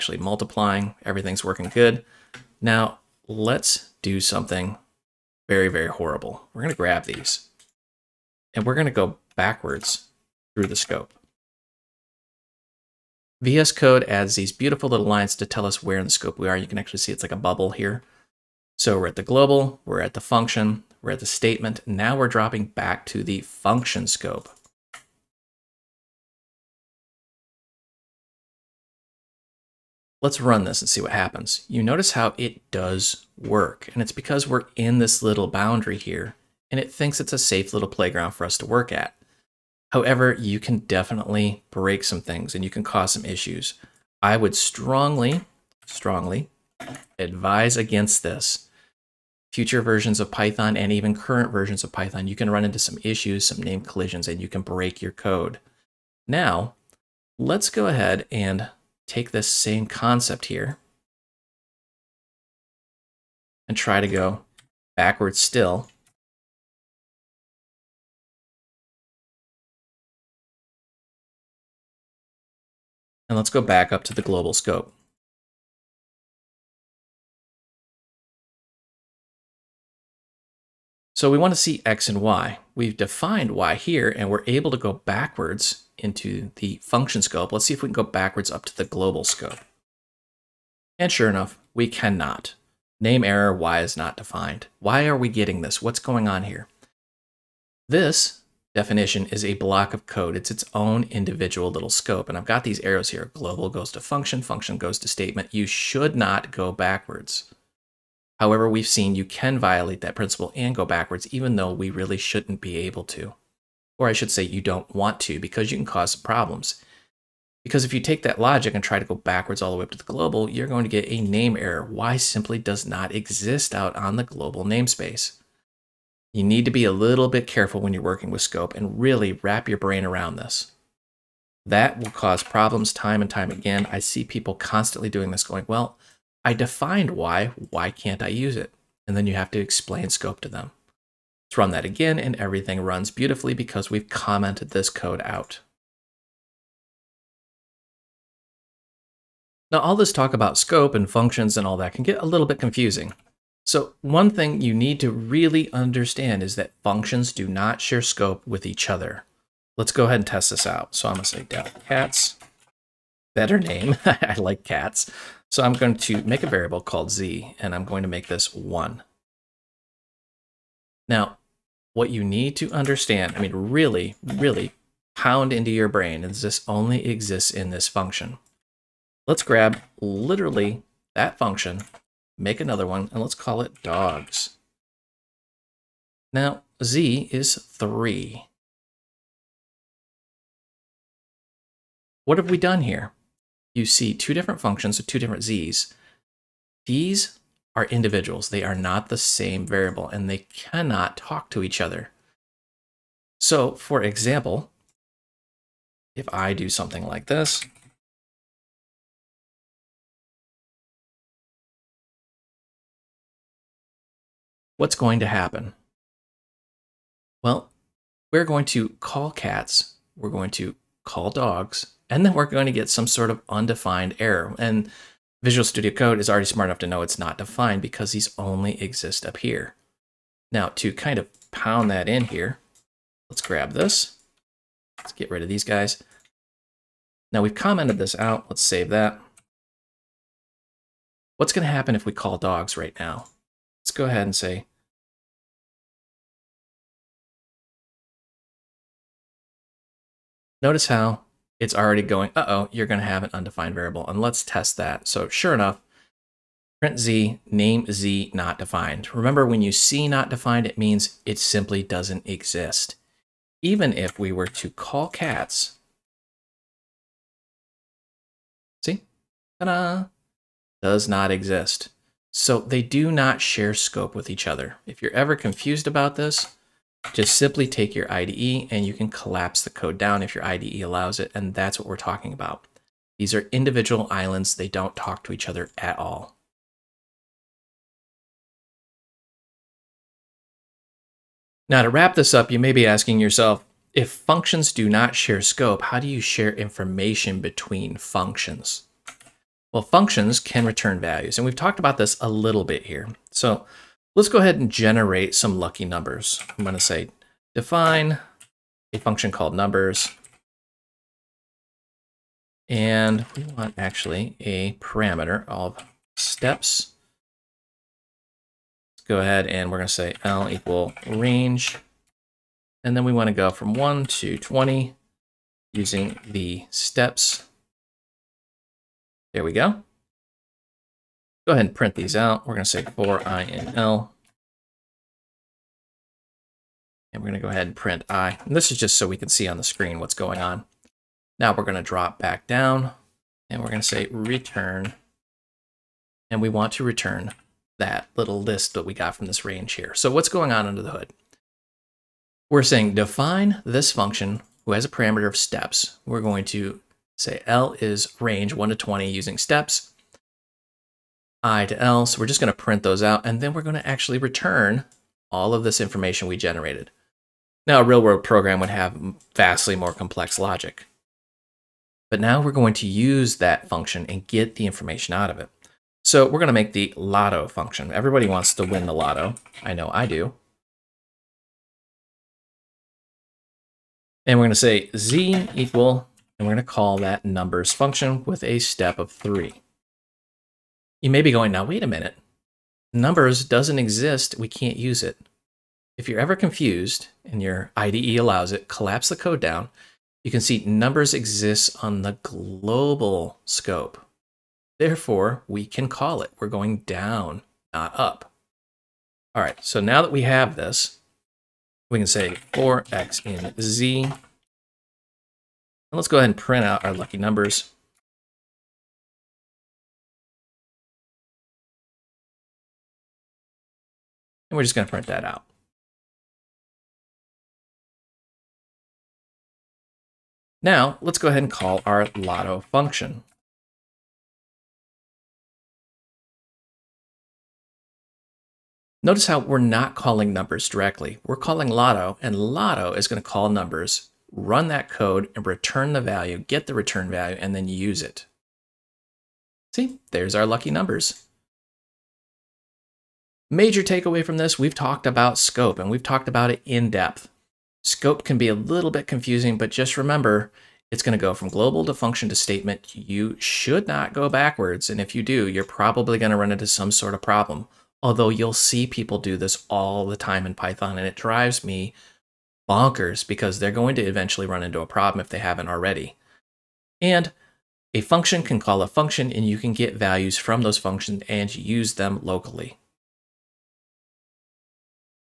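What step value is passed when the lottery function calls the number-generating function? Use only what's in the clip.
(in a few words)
3.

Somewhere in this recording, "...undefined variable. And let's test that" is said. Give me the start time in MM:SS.
04:13.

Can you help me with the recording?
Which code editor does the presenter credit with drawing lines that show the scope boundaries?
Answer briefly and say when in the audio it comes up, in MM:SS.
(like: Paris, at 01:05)
VS Code, at 00:13.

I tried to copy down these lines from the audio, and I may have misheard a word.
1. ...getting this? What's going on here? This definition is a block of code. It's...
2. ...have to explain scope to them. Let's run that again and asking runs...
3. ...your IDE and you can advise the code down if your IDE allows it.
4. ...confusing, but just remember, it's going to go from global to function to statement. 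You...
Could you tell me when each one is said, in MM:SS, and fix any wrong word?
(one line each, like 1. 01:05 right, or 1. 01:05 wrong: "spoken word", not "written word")
1. 01:35 right
2. 02:19 wrong: "everything", not "asking"
3. 04:37 wrong: "collapse", not "advise"
4. 07:39 right.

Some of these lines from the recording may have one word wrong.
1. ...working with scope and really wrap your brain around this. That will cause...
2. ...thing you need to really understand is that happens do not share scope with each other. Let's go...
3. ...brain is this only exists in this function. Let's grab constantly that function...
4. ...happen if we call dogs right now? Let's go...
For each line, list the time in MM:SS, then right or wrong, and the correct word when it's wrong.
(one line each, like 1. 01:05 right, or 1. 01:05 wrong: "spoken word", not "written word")
1. 02:08 right
2. 02:34 wrong: "functions", not "happens"
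3. 02:55 wrong: "literally", not "constantly"
4. 04:01 right.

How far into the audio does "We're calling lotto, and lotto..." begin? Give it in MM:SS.
07:21.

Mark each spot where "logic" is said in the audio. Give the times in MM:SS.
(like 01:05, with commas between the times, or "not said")
01:58, 06:10.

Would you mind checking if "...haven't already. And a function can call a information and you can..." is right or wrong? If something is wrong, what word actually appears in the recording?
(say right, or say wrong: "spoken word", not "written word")
wrong: "function", not "information".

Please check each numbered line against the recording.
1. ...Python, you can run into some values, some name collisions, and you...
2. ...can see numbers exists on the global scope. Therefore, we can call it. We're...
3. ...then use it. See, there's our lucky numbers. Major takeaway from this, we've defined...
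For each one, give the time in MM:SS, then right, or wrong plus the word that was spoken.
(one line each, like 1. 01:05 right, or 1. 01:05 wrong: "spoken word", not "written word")
1. 00:51 wrong: "issues", not "values"
2. 06:40 right
3. 07:27 wrong: "talked", not "defined".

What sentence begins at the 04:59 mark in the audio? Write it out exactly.
Well, functions can return values, and we've talked about this a little bit here.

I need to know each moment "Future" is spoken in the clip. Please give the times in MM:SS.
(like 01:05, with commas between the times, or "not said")
00:49.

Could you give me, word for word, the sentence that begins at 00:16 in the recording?
You can actually see it's like a bubble here.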